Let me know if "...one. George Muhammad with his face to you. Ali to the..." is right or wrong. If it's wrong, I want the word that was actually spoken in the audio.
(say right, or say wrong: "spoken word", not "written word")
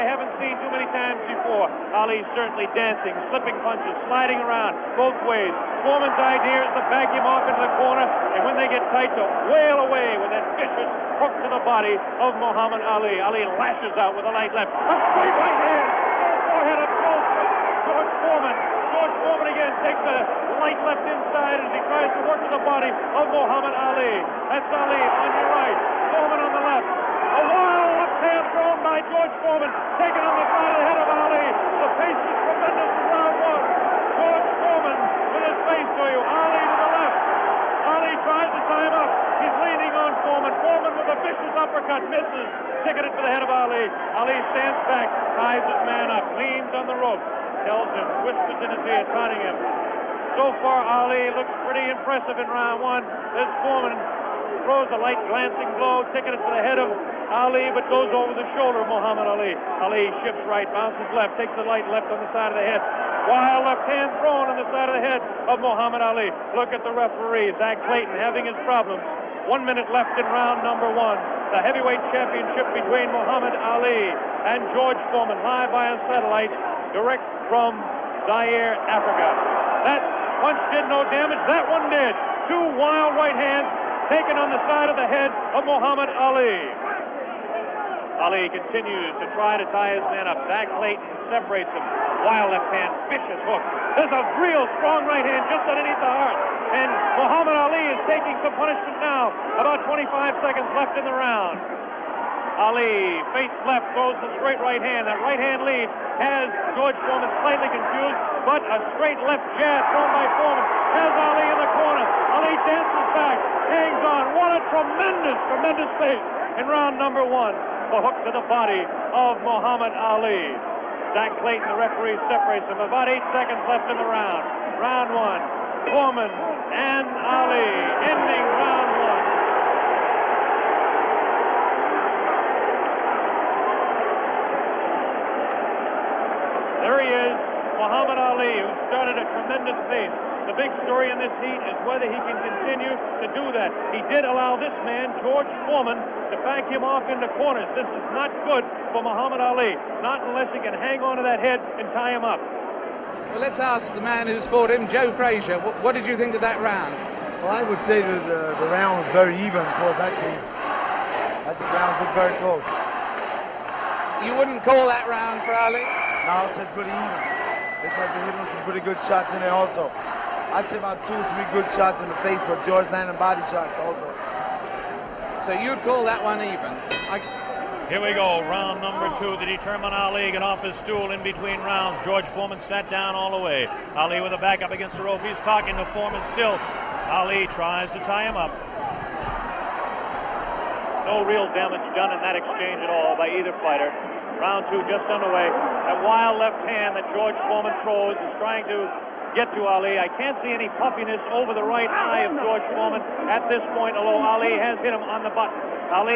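wrong: "Foreman", not "Muhammad".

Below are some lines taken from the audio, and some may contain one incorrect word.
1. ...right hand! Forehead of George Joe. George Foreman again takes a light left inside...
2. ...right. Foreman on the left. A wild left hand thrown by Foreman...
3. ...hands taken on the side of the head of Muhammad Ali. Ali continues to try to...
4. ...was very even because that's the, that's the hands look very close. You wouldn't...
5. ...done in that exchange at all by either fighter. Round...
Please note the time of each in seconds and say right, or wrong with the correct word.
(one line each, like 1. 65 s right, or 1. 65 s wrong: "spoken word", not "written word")
1. 15 s wrong: "Foreman", not "Joe"
2. 25 s wrong: "George", not "Foreman"
3. 83 s right
4. 159 s wrong: "rounds", not "hands"
5. 191 s right.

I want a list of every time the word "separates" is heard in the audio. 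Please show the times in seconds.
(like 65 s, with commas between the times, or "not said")
91 s, 122 s.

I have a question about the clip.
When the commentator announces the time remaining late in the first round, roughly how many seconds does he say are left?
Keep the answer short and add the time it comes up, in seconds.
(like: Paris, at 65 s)
25, at 99 s.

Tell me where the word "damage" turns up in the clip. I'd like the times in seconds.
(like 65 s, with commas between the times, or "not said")
81 s, 191 s.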